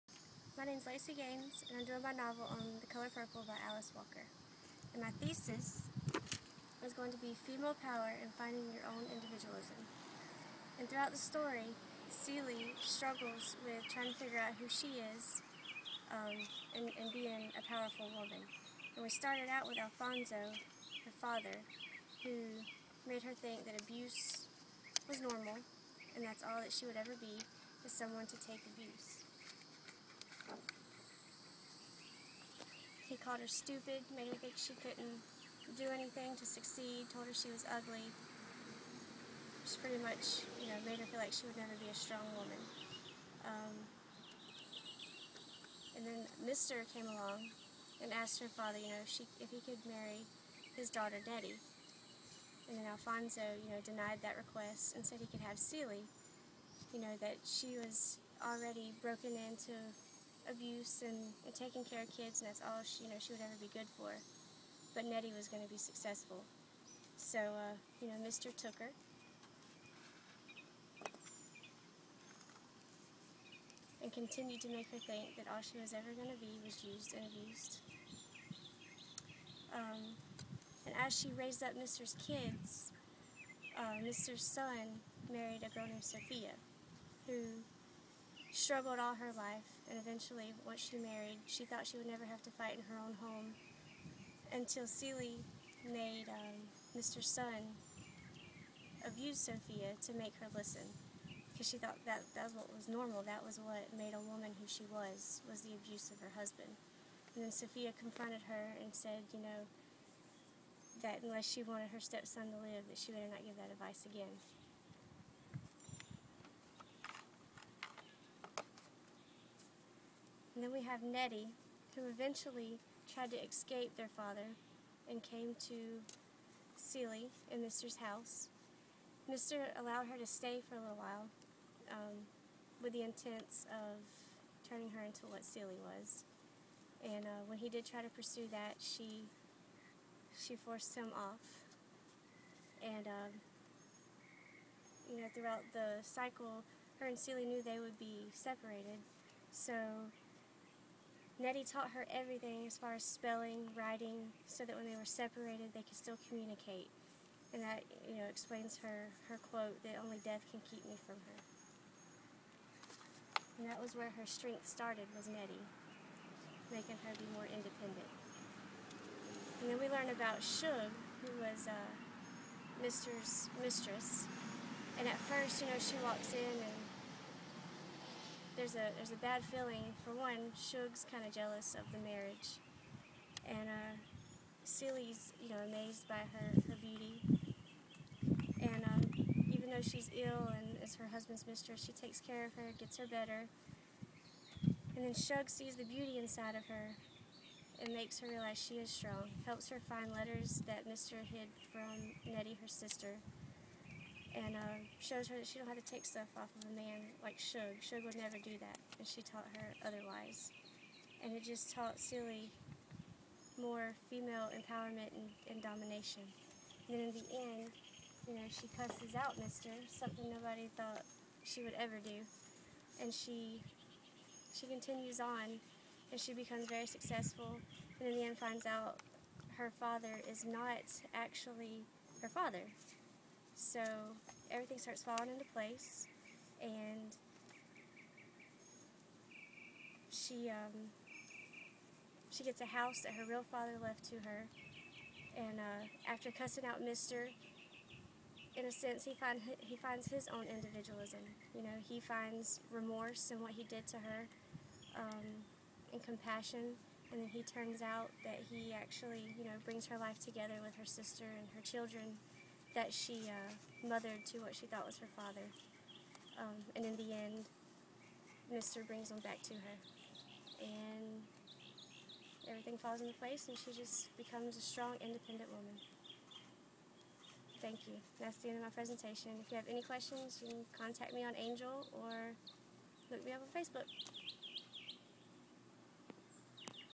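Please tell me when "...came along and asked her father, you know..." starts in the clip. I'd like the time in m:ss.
0:46.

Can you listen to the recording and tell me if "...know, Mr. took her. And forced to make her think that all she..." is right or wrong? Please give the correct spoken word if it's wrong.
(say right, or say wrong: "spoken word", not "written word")
wrong: "continued", not "forced".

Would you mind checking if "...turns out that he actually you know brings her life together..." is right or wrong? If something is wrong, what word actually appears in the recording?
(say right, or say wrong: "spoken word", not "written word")
right.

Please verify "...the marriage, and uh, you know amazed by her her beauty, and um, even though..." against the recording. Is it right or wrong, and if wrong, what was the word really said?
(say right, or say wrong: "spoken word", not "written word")
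right.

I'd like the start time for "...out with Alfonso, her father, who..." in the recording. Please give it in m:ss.
0:19.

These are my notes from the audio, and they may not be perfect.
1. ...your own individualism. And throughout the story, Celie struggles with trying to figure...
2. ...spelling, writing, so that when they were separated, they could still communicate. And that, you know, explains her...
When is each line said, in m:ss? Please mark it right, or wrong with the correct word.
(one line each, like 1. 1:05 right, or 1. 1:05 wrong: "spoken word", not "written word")
1. 0:08 right
2. 2:33 right.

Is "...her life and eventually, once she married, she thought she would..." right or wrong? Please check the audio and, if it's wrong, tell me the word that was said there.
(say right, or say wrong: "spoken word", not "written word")
right.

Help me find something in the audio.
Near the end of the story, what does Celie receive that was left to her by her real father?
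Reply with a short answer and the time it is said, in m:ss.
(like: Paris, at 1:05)
a house, at 4:02.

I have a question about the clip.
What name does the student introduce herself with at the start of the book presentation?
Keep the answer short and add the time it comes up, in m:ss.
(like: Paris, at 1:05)
Lacey Gaines, at 0:00.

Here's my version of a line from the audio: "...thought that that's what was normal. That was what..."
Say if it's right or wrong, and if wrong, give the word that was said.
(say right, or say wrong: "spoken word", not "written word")
right.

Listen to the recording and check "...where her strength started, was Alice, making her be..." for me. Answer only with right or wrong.
wrong.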